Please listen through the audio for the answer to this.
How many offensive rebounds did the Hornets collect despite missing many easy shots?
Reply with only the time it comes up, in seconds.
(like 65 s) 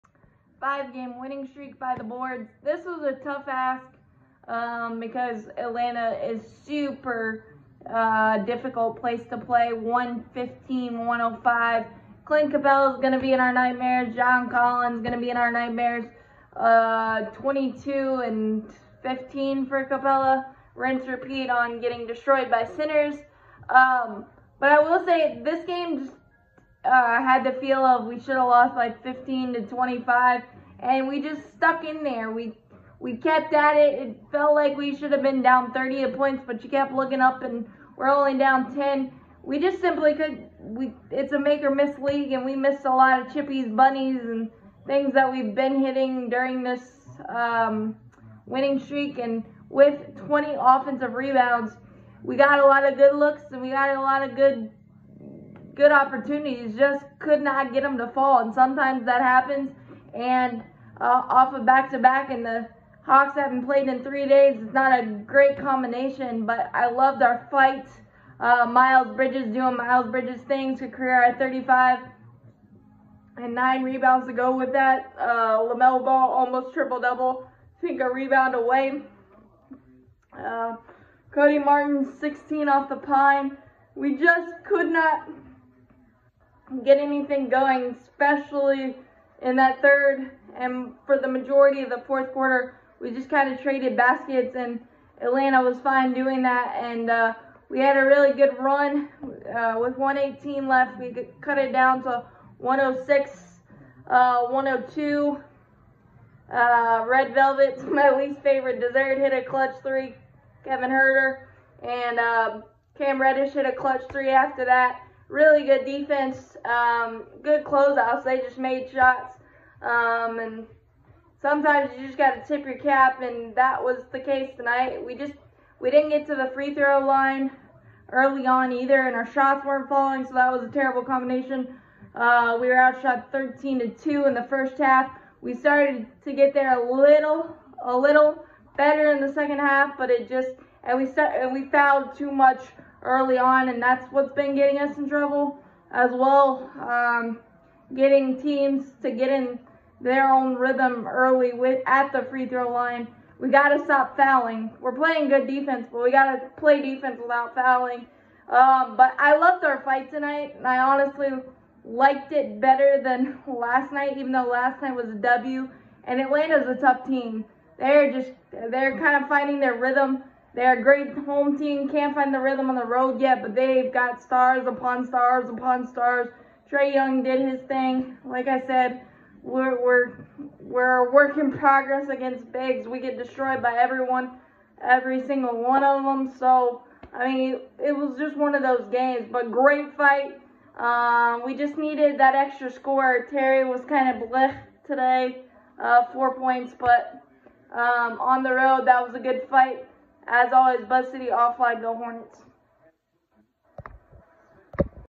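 50 s.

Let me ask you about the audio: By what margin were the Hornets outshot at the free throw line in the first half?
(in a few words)
13 to 2.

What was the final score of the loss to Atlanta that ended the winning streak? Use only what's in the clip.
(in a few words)
115-105.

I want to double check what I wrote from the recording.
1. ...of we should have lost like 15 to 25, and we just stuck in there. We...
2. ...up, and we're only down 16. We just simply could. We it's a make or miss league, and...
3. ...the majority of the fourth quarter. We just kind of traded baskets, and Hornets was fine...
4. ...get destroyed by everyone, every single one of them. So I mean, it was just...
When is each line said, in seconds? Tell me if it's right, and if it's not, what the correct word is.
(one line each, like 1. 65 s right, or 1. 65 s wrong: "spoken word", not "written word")
1. 27 s right
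2. 37 s wrong: "10", not "16"
3. 91 s wrong: "Atlanta", not "Hornets"
4. 182 s right.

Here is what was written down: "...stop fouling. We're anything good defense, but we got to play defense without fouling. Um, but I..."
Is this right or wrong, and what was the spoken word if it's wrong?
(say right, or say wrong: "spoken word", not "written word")
wrong: "playing", not "anything".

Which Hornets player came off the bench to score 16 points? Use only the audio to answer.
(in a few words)
Cody Martin.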